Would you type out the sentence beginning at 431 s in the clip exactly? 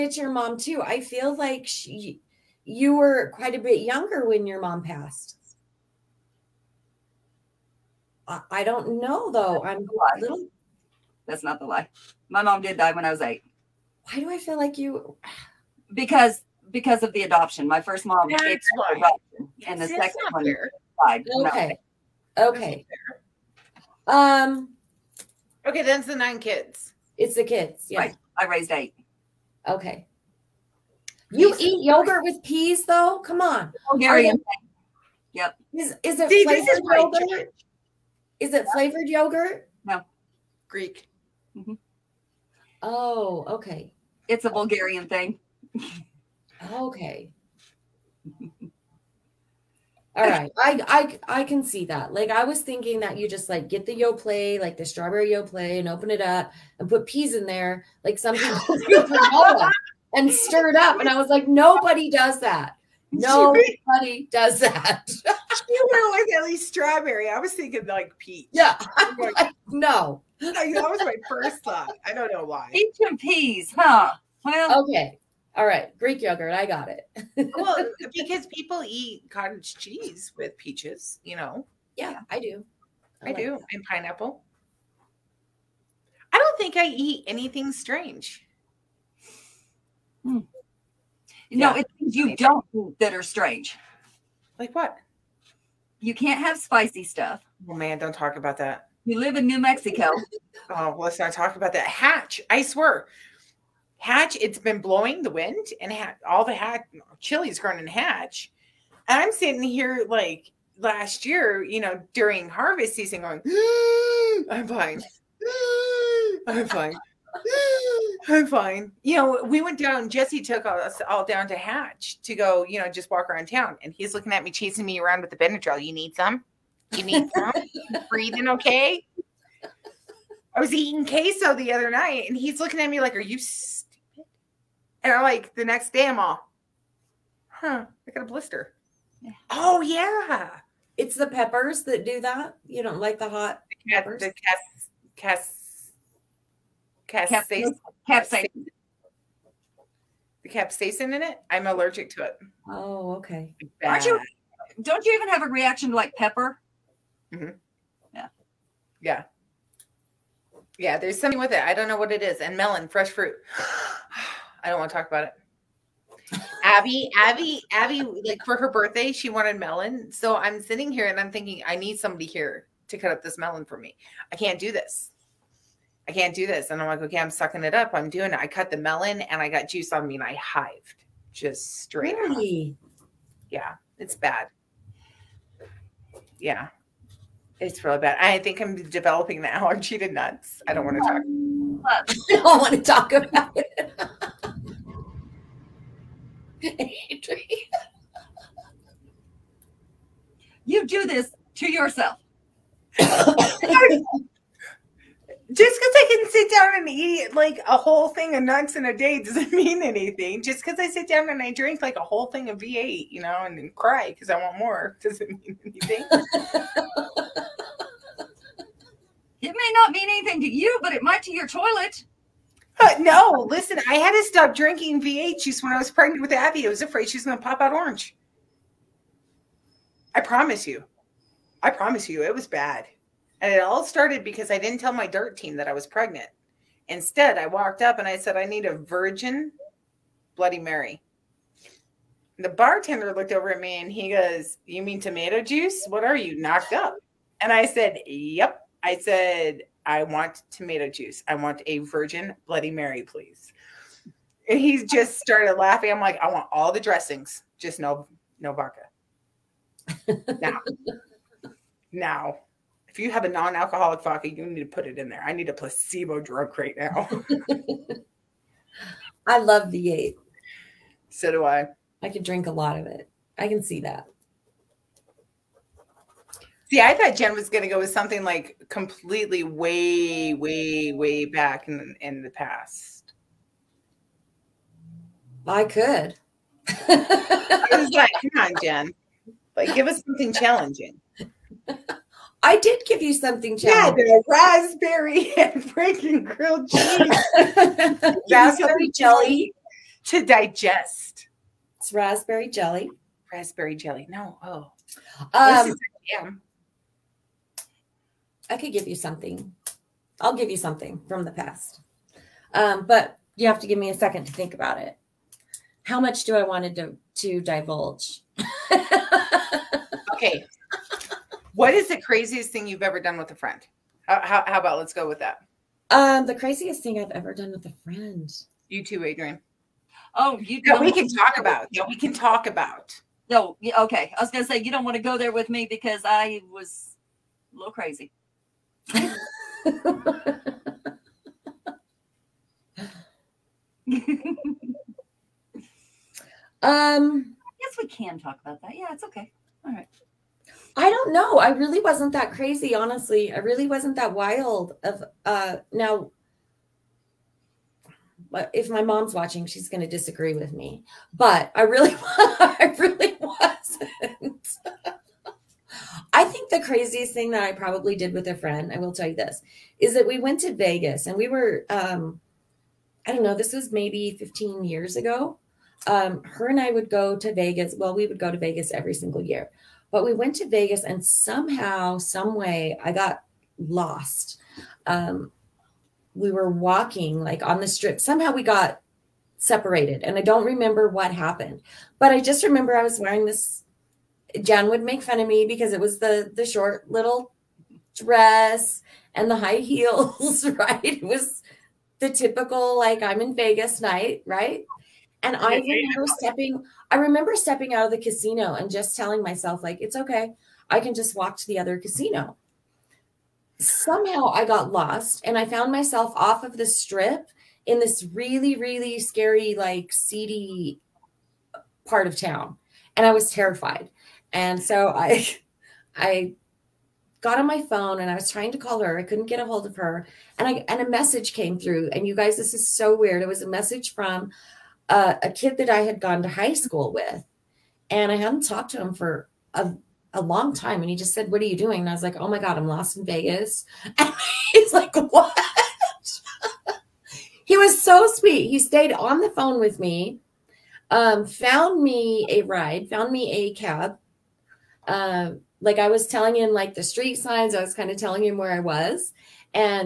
And you guys, this is so weird.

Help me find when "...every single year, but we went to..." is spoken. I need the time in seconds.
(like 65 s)
378 s.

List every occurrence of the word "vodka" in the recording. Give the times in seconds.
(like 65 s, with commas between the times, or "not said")
258 s, 264 s.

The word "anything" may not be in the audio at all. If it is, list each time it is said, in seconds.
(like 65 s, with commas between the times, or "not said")
87 s, 209 s, 215 s, 220 s.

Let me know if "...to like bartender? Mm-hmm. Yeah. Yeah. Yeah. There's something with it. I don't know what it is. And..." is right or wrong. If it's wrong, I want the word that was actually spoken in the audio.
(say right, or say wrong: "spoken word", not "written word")
wrong: "pepper", not "bartender".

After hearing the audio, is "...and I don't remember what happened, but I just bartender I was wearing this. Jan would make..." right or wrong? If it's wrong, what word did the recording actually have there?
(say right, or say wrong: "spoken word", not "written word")
wrong: "remember", not "bartender".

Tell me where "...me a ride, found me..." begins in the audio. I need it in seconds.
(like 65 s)
451 s.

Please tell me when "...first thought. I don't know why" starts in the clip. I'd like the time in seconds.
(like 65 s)
71 s.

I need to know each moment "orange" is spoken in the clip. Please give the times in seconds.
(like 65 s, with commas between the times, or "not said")
227 s.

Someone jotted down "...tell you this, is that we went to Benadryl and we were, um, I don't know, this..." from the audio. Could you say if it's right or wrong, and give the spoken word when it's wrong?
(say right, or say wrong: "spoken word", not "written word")
wrong: "Vegas", not "Benadryl".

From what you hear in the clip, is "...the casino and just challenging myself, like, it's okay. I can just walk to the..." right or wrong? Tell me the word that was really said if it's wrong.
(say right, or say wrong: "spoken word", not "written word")
wrong: "telling", not "challenging".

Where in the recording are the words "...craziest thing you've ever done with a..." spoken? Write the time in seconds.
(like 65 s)
321 s.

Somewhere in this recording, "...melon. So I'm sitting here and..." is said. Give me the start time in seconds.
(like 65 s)
169 s.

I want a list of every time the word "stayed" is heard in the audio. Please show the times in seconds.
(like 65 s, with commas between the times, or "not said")
448 s.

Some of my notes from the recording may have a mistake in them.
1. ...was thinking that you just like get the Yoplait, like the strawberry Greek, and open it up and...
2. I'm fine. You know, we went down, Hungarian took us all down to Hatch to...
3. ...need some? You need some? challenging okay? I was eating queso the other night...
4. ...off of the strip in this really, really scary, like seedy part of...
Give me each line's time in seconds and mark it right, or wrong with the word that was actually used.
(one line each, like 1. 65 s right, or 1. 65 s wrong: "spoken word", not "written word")
1. 52 s wrong: "Yoplait", not "Greek"
2. 118 s wrong: "Jesse", not "Hungarian"
3. 125 s wrong: "breathing", not "challenging"
4. 416 s right.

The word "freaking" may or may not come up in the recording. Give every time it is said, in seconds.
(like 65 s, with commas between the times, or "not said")
295 s.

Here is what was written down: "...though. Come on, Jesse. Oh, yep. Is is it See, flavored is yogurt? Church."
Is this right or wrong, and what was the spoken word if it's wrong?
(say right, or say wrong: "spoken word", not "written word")
wrong: "Hungarian", not "Jesse".